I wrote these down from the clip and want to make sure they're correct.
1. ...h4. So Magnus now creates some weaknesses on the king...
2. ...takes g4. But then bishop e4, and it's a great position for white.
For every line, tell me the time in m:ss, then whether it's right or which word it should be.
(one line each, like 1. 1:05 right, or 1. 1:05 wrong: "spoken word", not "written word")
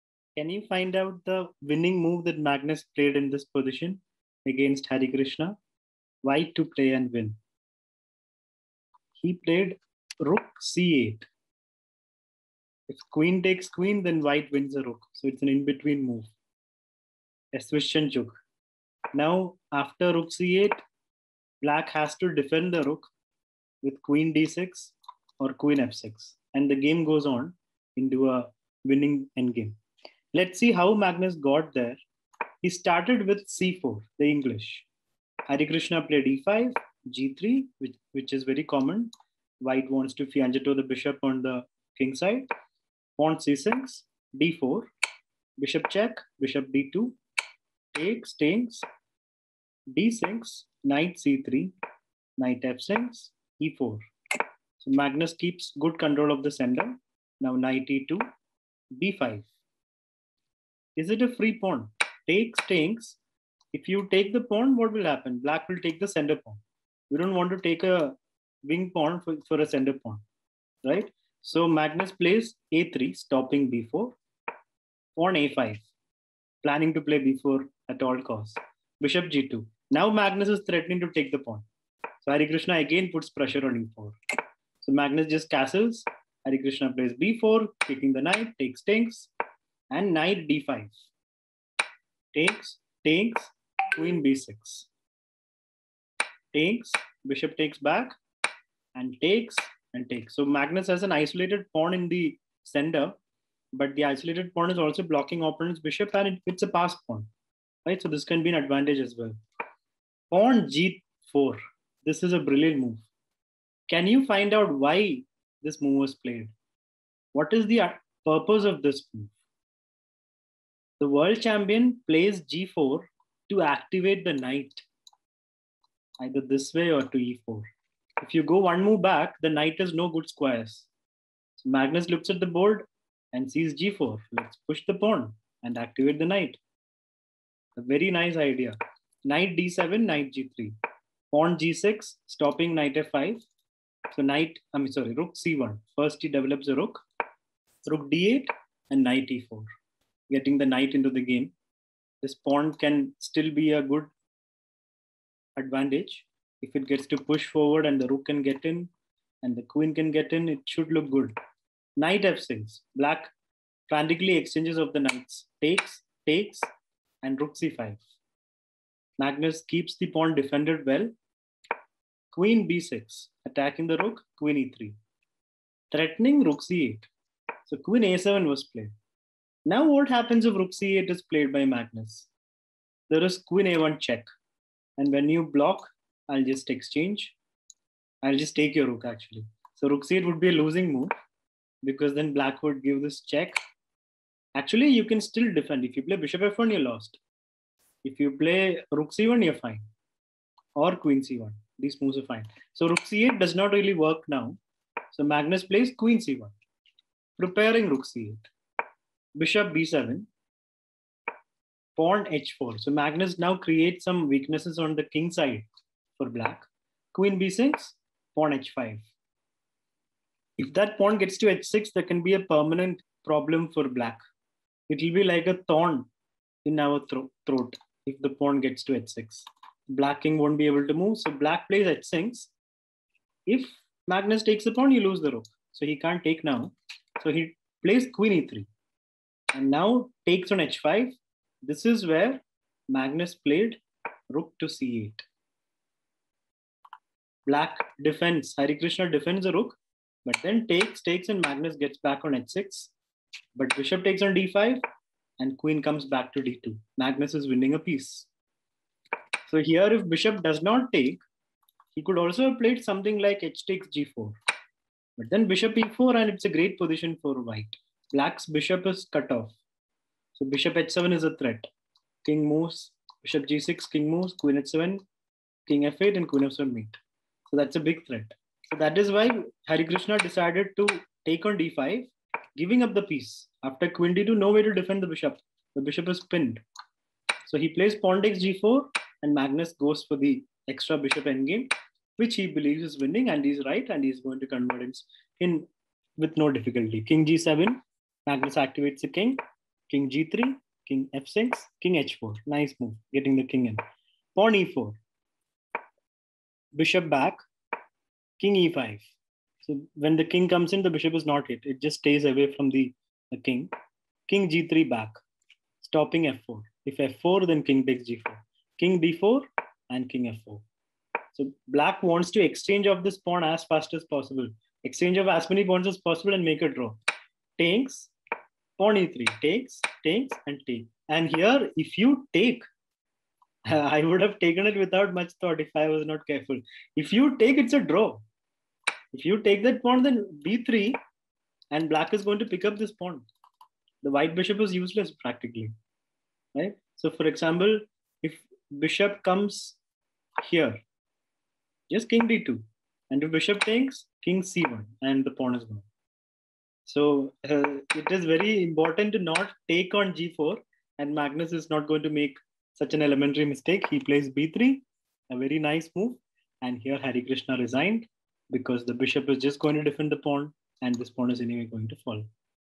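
1. 3:32 right
2. 4:23 right.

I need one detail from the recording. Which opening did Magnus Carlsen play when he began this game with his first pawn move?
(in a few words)
The English.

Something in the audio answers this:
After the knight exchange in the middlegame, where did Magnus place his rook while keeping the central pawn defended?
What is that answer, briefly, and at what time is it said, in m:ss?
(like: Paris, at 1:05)
c5, at 2:47.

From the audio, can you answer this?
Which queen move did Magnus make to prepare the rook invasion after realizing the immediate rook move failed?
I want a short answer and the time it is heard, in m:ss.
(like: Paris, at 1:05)
queen c1, at 3:25.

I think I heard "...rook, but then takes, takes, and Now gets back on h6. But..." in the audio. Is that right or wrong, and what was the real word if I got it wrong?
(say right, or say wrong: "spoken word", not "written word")
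wrong: "Magnus", not "Now".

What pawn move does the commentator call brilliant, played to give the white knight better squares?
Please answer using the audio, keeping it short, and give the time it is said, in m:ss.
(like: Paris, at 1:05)
g4, at 1:50.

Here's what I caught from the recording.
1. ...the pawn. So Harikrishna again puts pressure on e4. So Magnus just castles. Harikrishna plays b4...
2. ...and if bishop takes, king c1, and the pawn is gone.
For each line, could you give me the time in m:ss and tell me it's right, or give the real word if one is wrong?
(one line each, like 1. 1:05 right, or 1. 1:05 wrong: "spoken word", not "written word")
1. 1:21 right
2. 5:53 right.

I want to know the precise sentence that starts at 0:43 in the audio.
Pawn C6, D4, bishop check, bishop D2, takes, takes, D6, knight C3, knight F6, E4.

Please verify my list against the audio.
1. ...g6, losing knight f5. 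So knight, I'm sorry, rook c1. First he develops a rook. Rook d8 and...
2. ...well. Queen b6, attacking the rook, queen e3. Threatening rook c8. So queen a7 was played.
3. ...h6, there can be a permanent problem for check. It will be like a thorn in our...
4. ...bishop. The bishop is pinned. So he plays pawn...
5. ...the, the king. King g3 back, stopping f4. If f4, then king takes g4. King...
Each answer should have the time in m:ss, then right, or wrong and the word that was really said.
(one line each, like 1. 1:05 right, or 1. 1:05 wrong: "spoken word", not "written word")
1. 2:21 wrong: "stopping", not "losing"
2. 2:50 right
3. 3:41 wrong: "black", not "check"
4. 4:45 right
5. 5:12 right.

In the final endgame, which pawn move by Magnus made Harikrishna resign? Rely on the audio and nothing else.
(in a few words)
b3.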